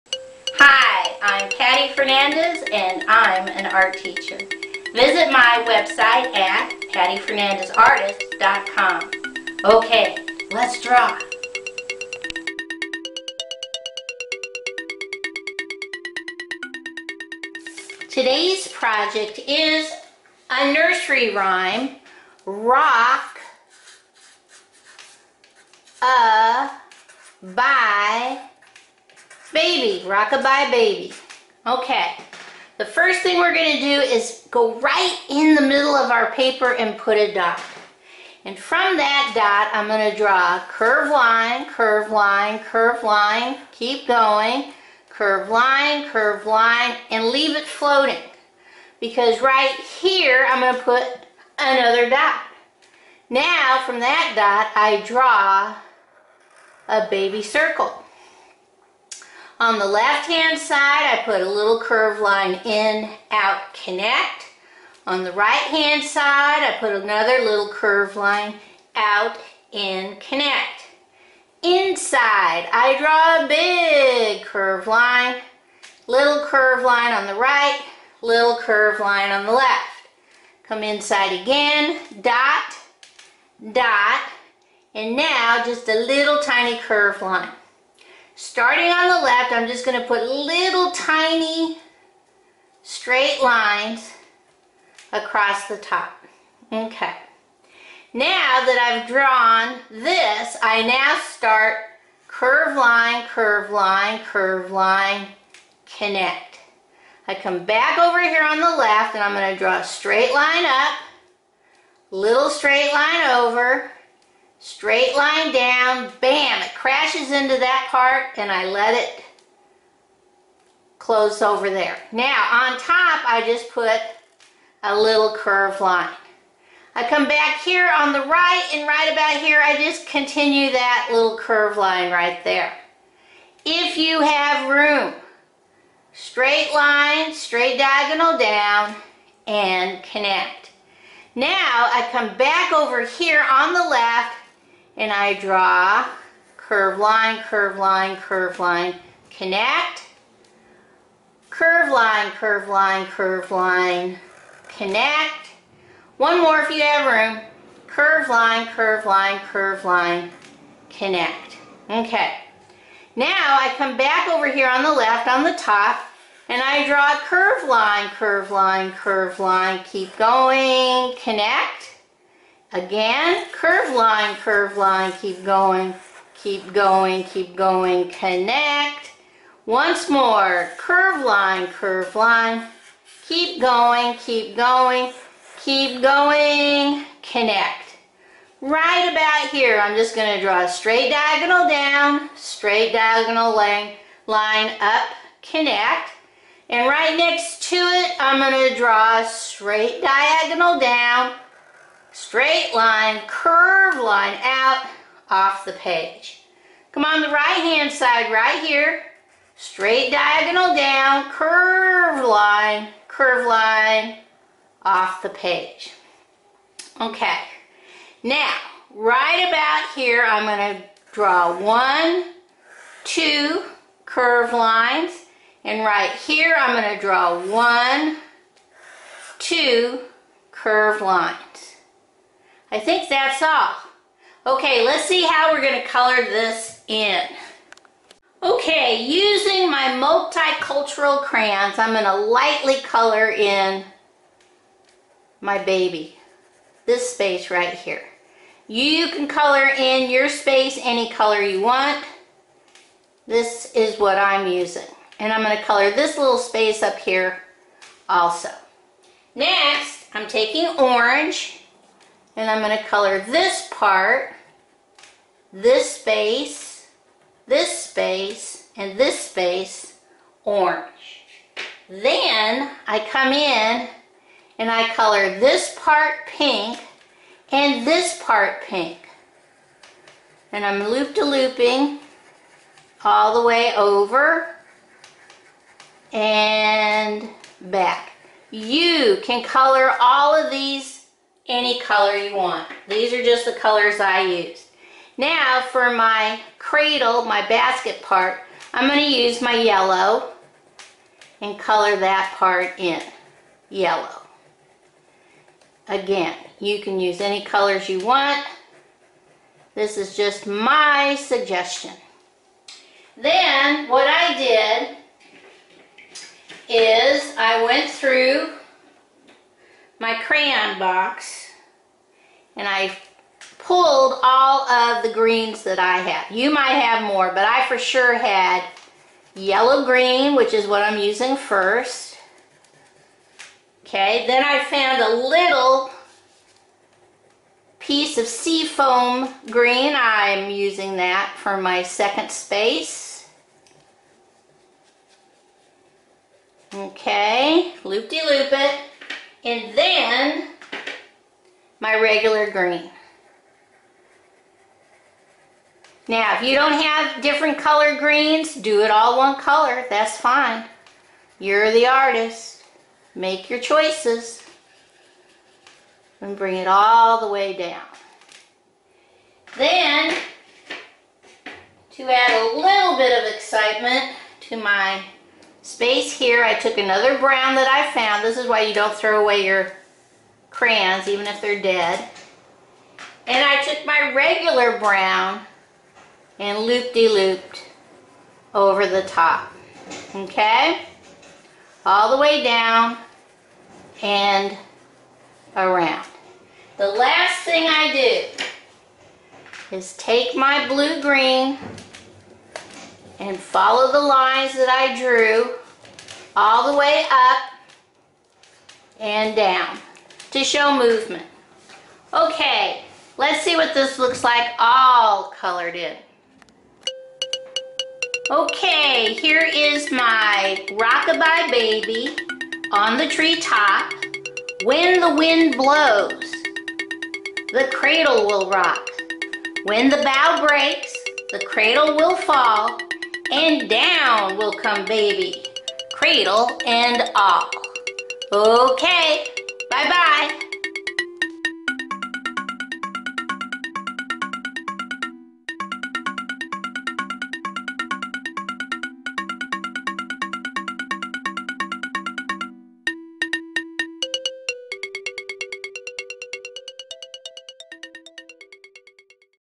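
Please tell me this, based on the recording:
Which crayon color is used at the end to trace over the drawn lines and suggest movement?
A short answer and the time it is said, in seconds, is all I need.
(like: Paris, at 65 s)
blue-green, at 400 s.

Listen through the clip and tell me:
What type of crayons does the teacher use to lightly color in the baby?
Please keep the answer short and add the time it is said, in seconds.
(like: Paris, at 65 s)
multicultural crayons, at 240 s.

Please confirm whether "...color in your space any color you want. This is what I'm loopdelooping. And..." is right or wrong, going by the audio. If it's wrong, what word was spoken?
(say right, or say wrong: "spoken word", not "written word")
wrong: "using", not "loopdelooping".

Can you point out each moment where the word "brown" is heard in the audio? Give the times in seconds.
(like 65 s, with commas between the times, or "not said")
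377 s, 384 s.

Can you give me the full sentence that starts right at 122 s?
Now on top I just put a little curved line.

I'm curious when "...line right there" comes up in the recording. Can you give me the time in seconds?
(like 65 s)
131 s.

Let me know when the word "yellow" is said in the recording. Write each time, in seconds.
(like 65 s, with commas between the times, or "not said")
299 s, 303 s, 329 s.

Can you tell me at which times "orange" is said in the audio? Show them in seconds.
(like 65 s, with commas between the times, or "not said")
260 s, 270 s.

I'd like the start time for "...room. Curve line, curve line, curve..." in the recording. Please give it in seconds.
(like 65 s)
157 s.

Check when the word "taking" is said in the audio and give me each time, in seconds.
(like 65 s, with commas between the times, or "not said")
260 s.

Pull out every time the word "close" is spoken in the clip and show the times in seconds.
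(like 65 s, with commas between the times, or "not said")
120 s.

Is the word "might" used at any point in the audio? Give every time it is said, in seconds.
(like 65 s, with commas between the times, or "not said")
326 s.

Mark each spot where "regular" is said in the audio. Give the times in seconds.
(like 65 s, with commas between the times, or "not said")
351 s, 384 s.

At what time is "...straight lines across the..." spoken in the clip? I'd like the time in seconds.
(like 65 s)
92 s.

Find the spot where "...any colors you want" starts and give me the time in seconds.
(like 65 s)
307 s.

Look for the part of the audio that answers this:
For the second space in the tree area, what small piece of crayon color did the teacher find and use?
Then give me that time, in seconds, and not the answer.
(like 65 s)
338 s.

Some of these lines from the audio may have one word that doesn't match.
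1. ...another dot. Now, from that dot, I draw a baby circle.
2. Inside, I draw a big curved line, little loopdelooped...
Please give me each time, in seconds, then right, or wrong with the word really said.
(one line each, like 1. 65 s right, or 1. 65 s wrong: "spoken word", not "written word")
1. 51 s right
2. 71 s wrong: "curved", not "loopdelooped".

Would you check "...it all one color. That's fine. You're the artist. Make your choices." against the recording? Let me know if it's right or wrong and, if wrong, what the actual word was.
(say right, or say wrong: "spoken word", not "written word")
right.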